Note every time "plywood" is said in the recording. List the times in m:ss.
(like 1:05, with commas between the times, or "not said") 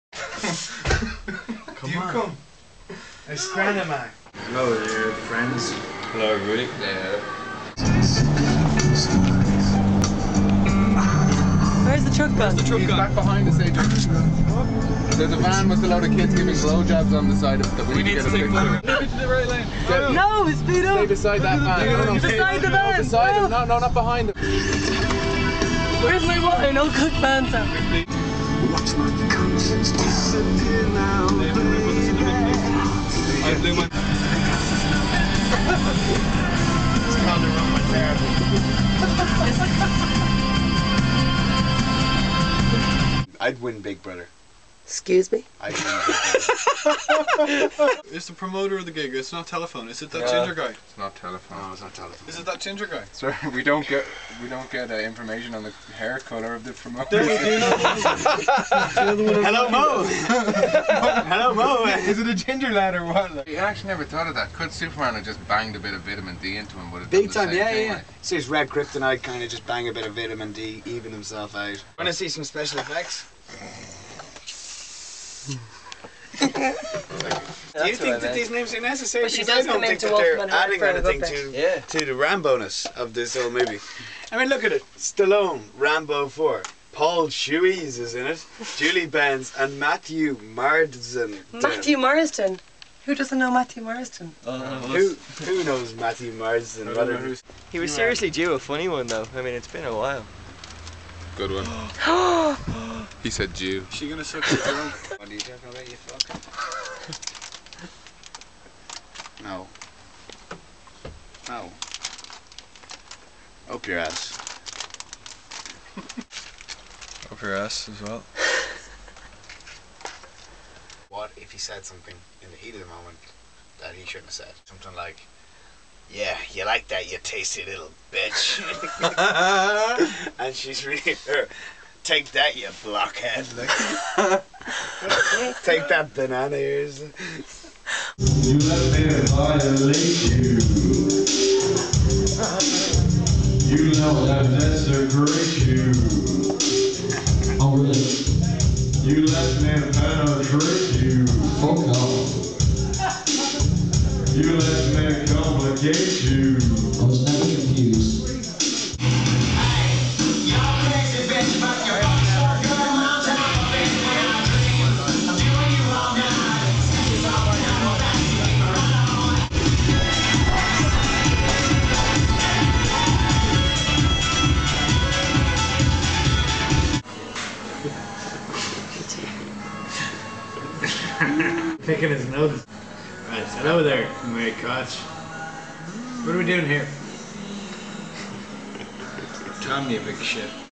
not said.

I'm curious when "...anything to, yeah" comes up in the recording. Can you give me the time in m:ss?
1:20.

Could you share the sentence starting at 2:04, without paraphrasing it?
Something like, yeah, you like that, you tasty little bitch.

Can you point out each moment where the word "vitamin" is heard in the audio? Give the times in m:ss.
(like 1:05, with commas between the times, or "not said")
1:06, 1:10.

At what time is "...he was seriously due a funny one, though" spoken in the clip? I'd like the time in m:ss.
1:37.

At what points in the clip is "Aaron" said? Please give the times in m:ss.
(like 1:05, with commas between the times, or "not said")
not said.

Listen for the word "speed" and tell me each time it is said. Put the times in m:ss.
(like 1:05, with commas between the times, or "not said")
0:20.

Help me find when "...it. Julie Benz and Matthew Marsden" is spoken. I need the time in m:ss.
1:28.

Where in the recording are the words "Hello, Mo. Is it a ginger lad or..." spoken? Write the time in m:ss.
1:00.